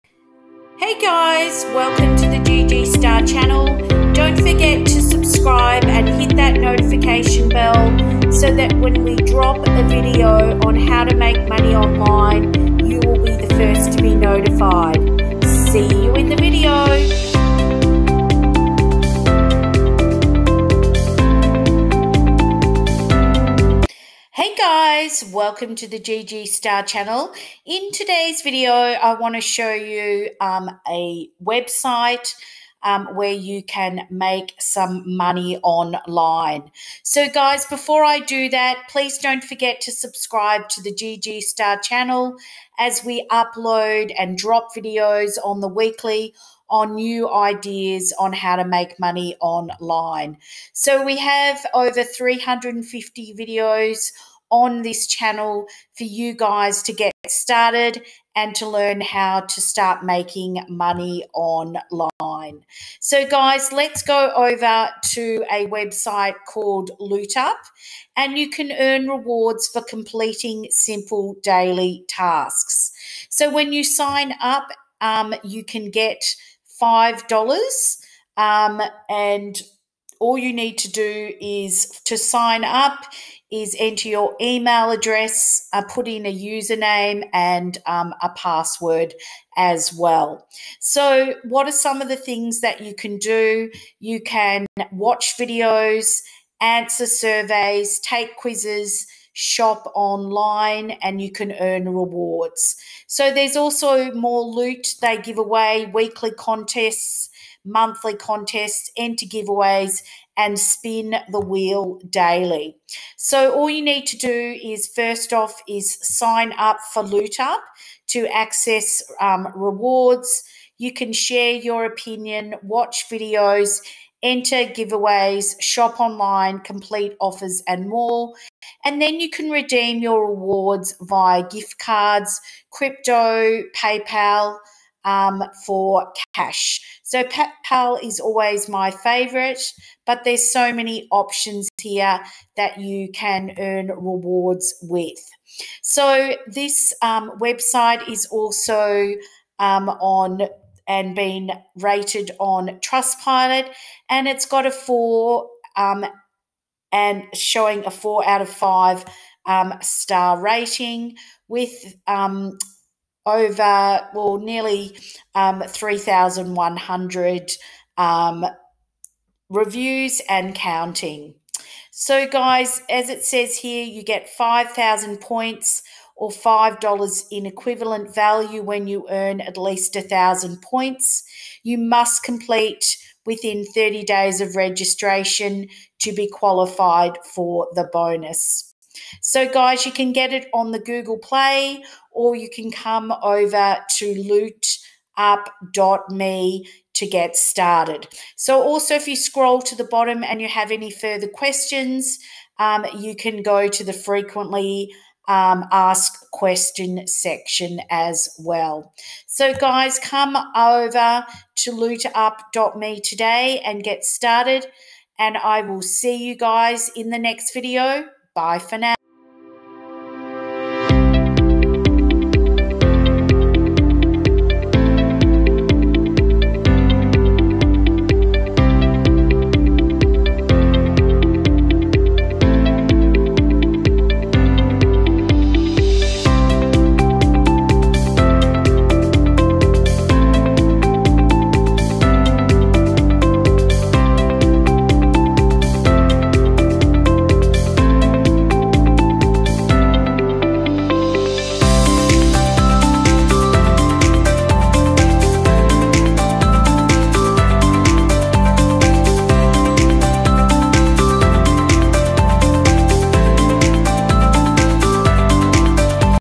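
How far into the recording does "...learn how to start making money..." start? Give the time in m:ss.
0:58.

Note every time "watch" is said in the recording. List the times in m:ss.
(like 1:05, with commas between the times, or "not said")
1:34, 2:02.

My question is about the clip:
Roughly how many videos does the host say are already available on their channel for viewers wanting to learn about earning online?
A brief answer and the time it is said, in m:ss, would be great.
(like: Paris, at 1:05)
over 350, at 0:51.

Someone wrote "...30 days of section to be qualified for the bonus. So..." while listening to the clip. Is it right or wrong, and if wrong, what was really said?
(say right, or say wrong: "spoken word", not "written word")
wrong: "registration", not "section".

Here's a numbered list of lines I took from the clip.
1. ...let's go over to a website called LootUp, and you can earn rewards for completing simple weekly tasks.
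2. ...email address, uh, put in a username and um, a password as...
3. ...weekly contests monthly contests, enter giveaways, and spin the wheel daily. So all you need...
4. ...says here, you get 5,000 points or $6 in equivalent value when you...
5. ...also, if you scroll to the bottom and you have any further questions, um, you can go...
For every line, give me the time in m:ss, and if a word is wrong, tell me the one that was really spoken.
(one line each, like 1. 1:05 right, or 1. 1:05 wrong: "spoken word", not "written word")
1. 1:03 wrong: "daily", not "weekly"
2. 1:24 right
3. 1:45 right
4. 2:53 wrong: "5", not "6"
5. 3:18 right.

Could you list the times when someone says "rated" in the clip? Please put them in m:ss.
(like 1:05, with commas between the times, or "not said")
2:31.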